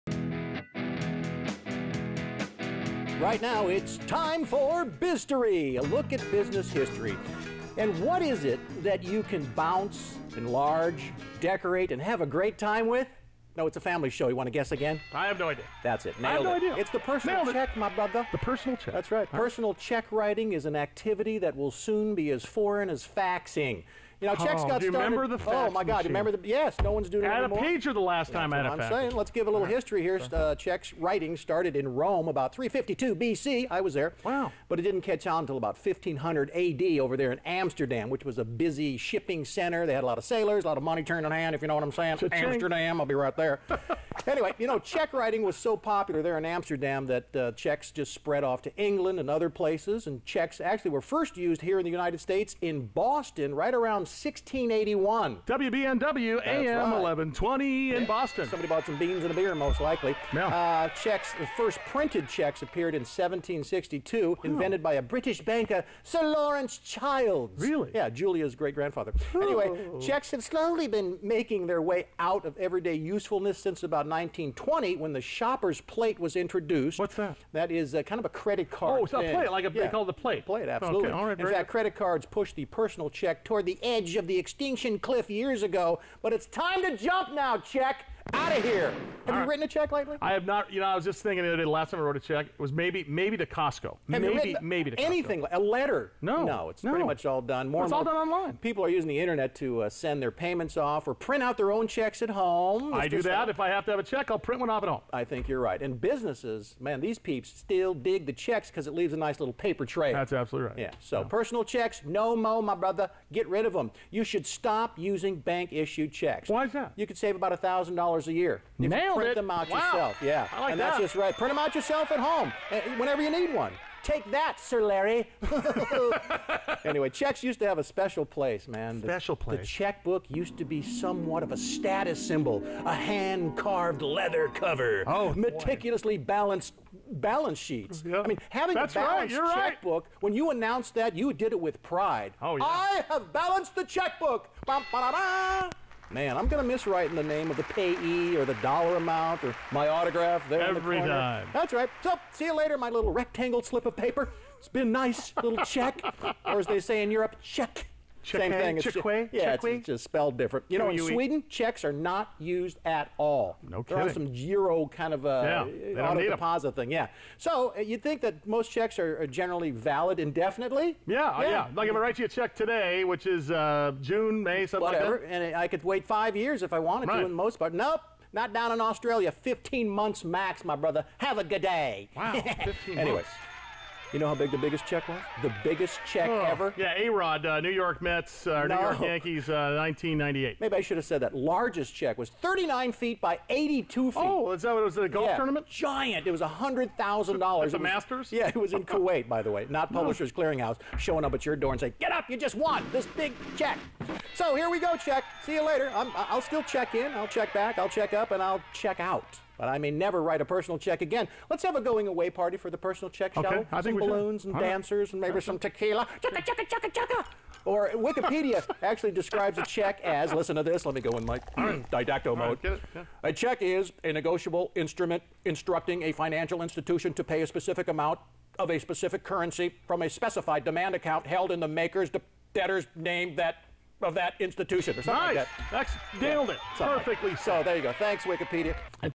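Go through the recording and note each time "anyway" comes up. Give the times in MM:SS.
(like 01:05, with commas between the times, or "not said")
00:44, 01:09, 02:06, 03:02.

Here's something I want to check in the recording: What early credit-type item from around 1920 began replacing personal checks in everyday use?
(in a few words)
shopper's plate.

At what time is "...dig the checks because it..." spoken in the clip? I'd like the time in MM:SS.
01:47.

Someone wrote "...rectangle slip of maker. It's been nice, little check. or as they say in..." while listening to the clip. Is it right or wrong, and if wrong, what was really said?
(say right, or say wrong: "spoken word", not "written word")
wrong: "paper", not "maker".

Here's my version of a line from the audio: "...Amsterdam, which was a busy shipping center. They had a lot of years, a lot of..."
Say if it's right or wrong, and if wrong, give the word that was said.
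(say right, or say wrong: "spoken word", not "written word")
wrong: "sailors", not "years".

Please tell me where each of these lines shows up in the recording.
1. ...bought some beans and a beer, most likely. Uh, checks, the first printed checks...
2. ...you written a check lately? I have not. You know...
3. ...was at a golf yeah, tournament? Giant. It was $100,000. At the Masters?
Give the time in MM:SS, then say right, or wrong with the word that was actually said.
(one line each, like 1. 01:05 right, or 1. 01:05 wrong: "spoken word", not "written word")
1. 00:58 right
2. 01:29 right
3. 03:14 right.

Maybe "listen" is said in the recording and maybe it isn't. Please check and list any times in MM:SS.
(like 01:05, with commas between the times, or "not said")
03:40.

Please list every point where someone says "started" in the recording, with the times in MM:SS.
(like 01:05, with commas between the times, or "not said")
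00:24, 00:31.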